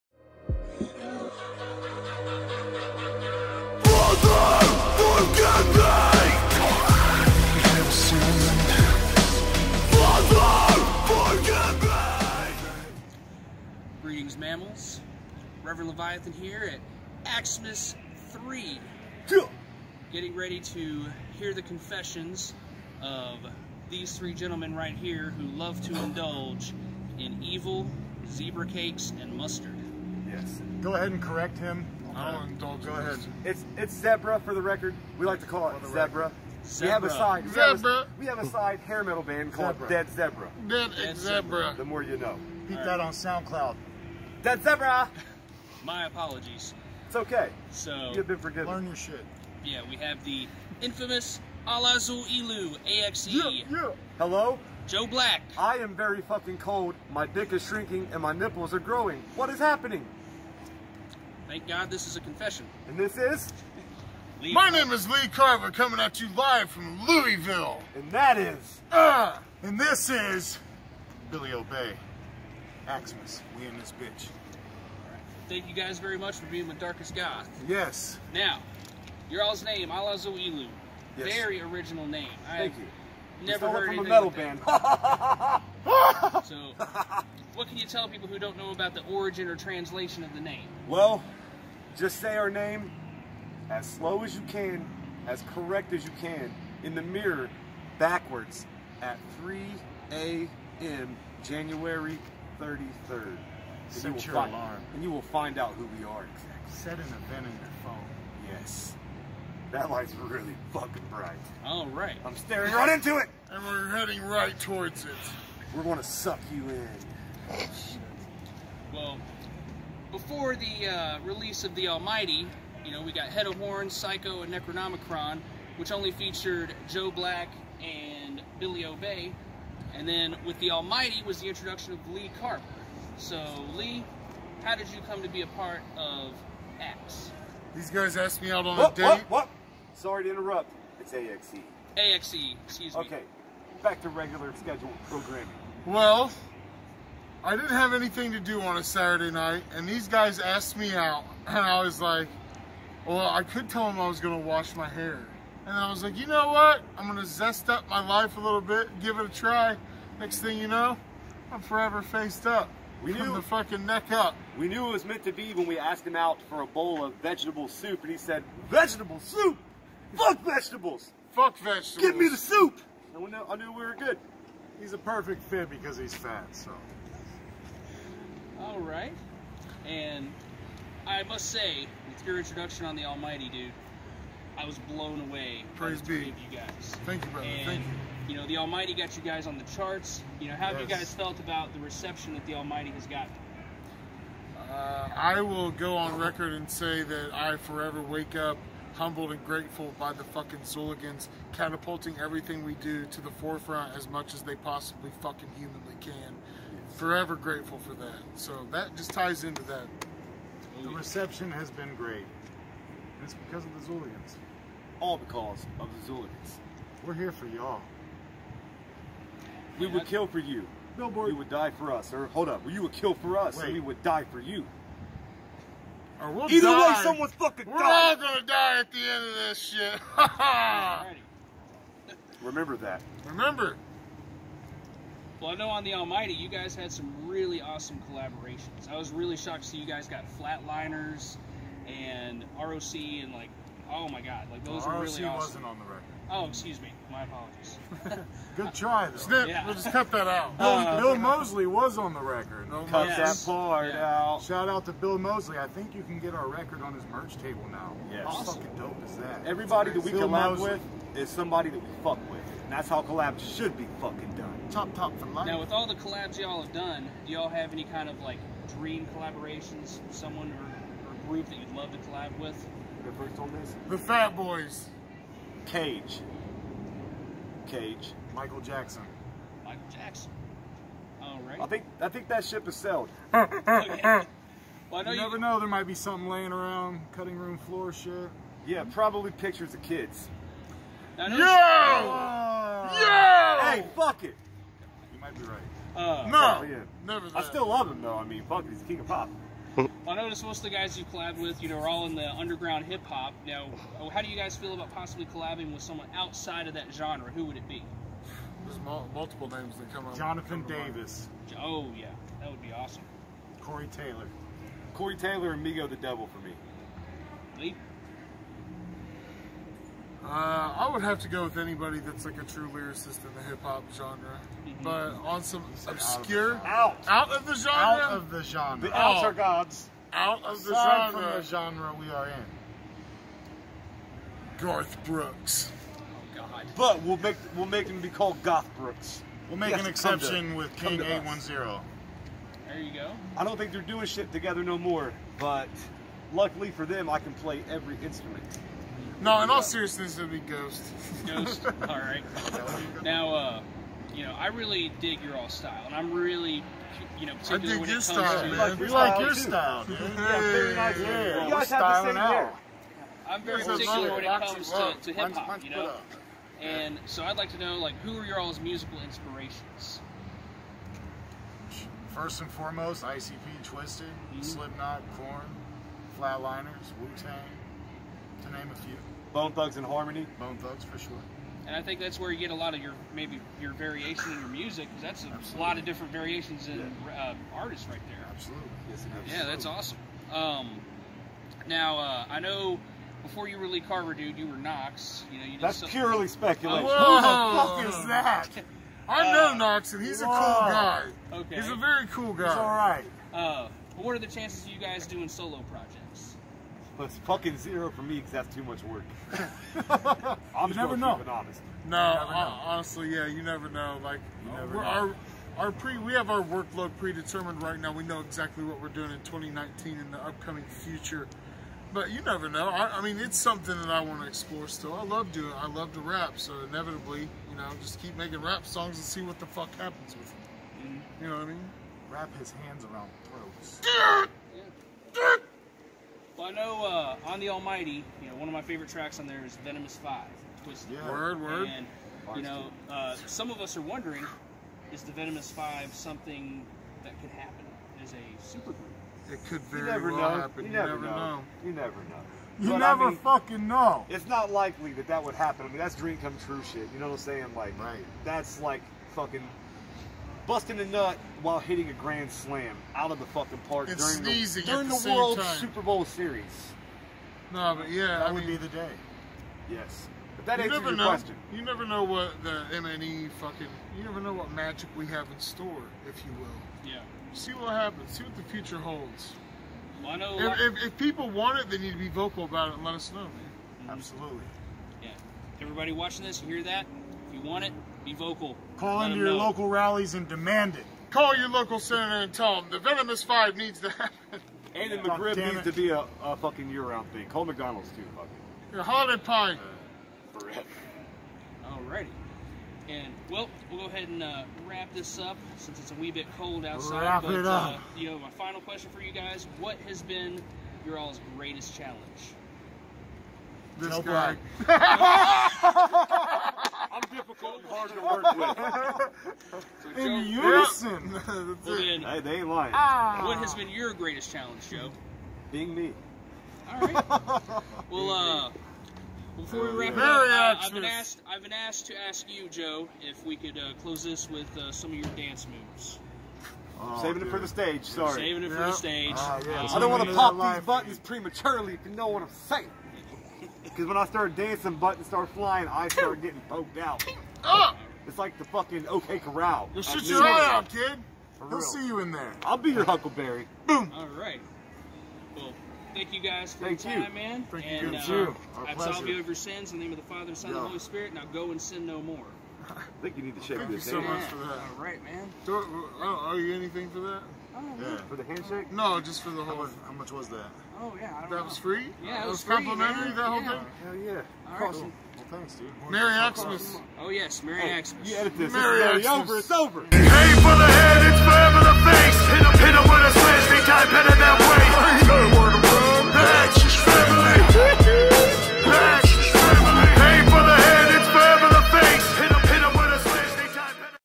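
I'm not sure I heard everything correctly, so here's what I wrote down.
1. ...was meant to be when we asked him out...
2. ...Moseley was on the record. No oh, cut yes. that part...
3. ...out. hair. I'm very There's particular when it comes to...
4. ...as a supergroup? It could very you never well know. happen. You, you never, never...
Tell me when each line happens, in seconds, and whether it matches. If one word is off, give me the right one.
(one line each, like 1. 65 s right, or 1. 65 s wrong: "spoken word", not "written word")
1. 164 s right
2. 251 s right
3. 362 s right
4. 448 s right.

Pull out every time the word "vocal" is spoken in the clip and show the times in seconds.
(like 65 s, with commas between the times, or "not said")
482 s, 488 s.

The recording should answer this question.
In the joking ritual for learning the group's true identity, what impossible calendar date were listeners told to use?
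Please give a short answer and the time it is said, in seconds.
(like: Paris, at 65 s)
January 33rd, at 101 s.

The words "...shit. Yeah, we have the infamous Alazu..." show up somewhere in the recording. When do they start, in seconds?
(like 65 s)
48 s.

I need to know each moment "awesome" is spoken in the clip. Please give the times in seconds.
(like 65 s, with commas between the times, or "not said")
237 s, 245 s, 258 s, 312 s, 389 s, 574 s.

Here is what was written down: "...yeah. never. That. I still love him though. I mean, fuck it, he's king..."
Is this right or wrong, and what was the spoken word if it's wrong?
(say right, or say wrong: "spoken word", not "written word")
right.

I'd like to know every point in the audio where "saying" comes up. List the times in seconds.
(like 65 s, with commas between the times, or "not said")
457 s, 542 s.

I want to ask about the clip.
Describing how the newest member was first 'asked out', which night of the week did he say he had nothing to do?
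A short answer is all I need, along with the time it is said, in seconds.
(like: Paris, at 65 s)
Saturday night, at 148 s.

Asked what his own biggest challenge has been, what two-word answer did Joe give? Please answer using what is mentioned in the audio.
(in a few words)
Being me.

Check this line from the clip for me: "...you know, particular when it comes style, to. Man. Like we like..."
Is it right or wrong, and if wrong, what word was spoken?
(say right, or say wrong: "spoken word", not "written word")
right.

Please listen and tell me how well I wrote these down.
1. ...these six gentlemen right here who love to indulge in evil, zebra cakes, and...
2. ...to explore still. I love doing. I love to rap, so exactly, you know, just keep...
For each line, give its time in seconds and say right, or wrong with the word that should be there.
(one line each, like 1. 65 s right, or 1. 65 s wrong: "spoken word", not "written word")
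1. 23 s wrong: "three", not "six"
2. 424 s wrong: "inevitably", not "exactly".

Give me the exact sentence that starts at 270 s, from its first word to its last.
Someone or group that you'd love to collab with?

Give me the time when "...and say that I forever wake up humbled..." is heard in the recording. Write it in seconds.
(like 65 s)
196 s.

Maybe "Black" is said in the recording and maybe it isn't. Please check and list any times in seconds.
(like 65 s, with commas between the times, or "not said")
55 s, 127 s.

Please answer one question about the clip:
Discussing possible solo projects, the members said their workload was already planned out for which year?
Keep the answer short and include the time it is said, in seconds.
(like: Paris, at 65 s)
2019, at 419 s.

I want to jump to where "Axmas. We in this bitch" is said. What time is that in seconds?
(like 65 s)
72 s.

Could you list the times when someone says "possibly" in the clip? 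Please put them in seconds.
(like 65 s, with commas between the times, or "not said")
204 s, 304 s.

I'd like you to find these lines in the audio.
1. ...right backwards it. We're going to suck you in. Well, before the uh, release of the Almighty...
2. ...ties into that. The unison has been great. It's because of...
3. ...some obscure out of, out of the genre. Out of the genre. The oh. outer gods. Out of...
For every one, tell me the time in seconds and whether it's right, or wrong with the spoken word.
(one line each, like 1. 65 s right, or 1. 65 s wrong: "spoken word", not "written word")
1. 114 s wrong: "towards", not "backwards"
2. 209 s wrong: "reception", not "unison"
3. 325 s right.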